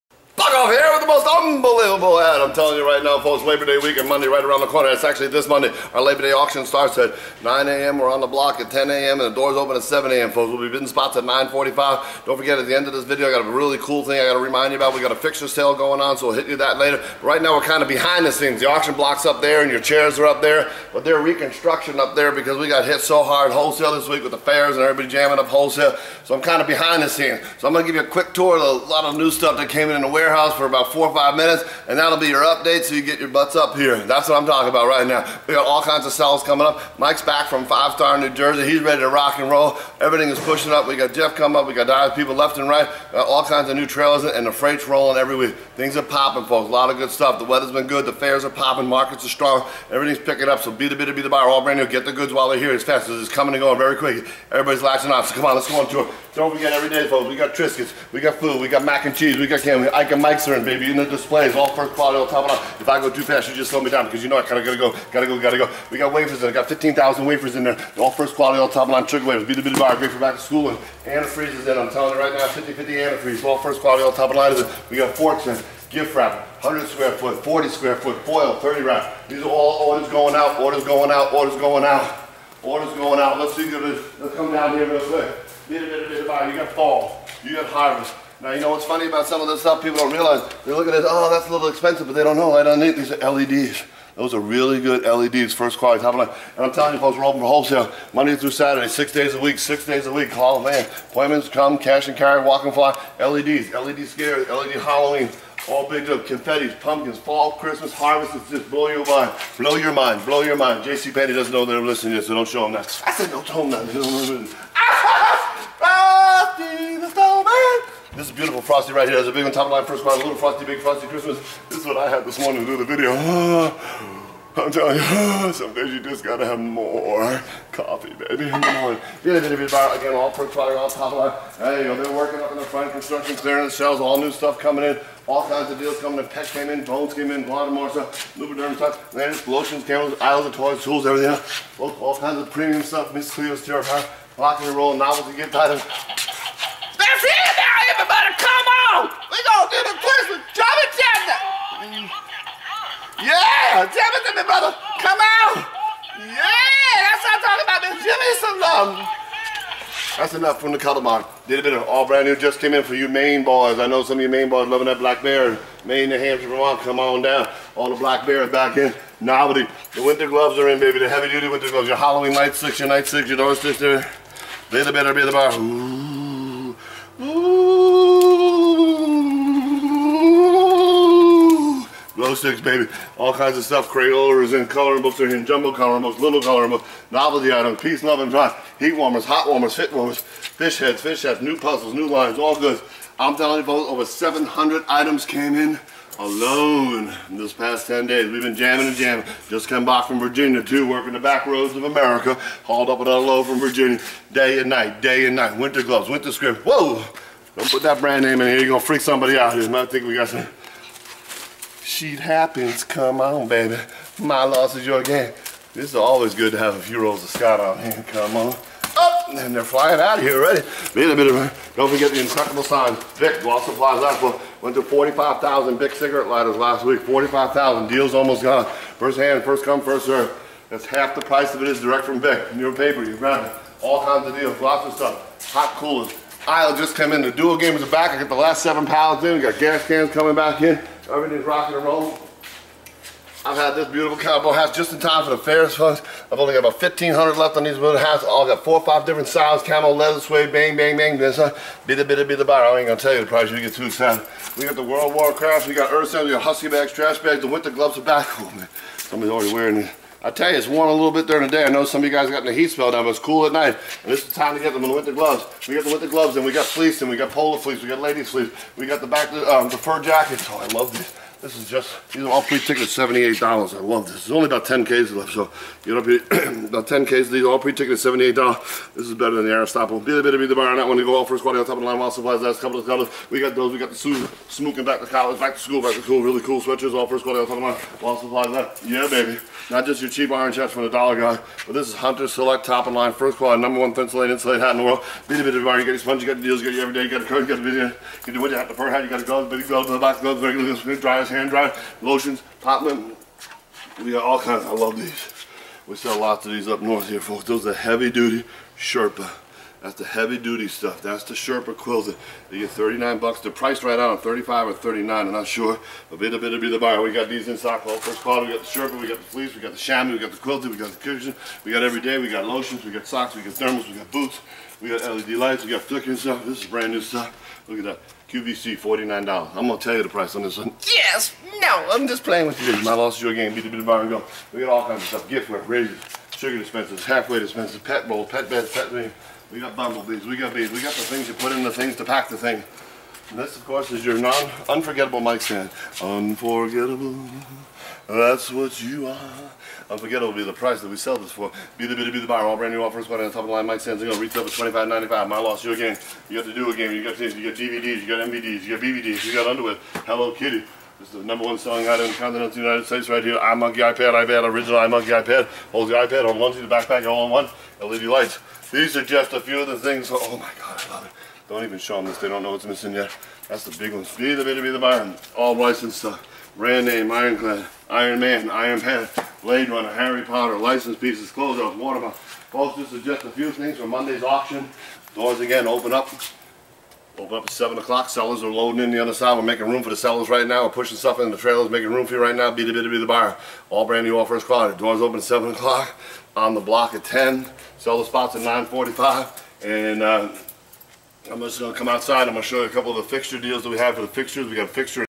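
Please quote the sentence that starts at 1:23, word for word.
Let's see, let's come down here real quick.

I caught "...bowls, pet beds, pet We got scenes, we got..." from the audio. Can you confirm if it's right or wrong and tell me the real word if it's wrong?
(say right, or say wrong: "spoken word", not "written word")
wrong: "bumblebees", not "scenes".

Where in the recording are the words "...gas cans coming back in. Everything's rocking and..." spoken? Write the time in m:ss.
3:59.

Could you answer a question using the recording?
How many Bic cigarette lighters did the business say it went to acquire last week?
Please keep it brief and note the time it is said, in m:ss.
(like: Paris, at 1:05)
45,000, at 3:44.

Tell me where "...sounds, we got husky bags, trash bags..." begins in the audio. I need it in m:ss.
4:16.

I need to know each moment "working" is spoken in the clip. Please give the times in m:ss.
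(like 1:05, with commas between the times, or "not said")
2:12, 3:20.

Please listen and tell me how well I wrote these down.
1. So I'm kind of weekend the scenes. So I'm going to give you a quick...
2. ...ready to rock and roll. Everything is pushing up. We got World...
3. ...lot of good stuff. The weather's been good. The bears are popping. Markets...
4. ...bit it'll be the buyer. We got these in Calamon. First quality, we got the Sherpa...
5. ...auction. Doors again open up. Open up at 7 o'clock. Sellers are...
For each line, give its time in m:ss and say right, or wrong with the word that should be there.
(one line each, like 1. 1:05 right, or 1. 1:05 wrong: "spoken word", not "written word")
1. 0:26 wrong: "behind", not "weekend"
2. 0:38 wrong: "Jeff", not "World"
3. 0:46 wrong: "fairs", not "bears"
4. 5:16 wrong: "Sockholm", not "Calamon"
5. 6:24 right.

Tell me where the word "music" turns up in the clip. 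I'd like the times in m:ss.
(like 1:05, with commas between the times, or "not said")
not said.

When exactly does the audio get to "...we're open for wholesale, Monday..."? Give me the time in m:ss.
1:37.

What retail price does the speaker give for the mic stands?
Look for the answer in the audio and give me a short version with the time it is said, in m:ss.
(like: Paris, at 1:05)
$25.95, at 5:54.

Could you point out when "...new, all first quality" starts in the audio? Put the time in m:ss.
6:34.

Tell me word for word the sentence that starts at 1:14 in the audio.
We got forks in, gift wrap, 100 square foot, 40 square foot, foil, 30 wrap.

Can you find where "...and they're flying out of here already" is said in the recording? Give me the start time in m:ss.
3:39.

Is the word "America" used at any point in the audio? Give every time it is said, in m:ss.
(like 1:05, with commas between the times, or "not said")
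3:21.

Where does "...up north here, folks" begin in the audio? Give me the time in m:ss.
5:06.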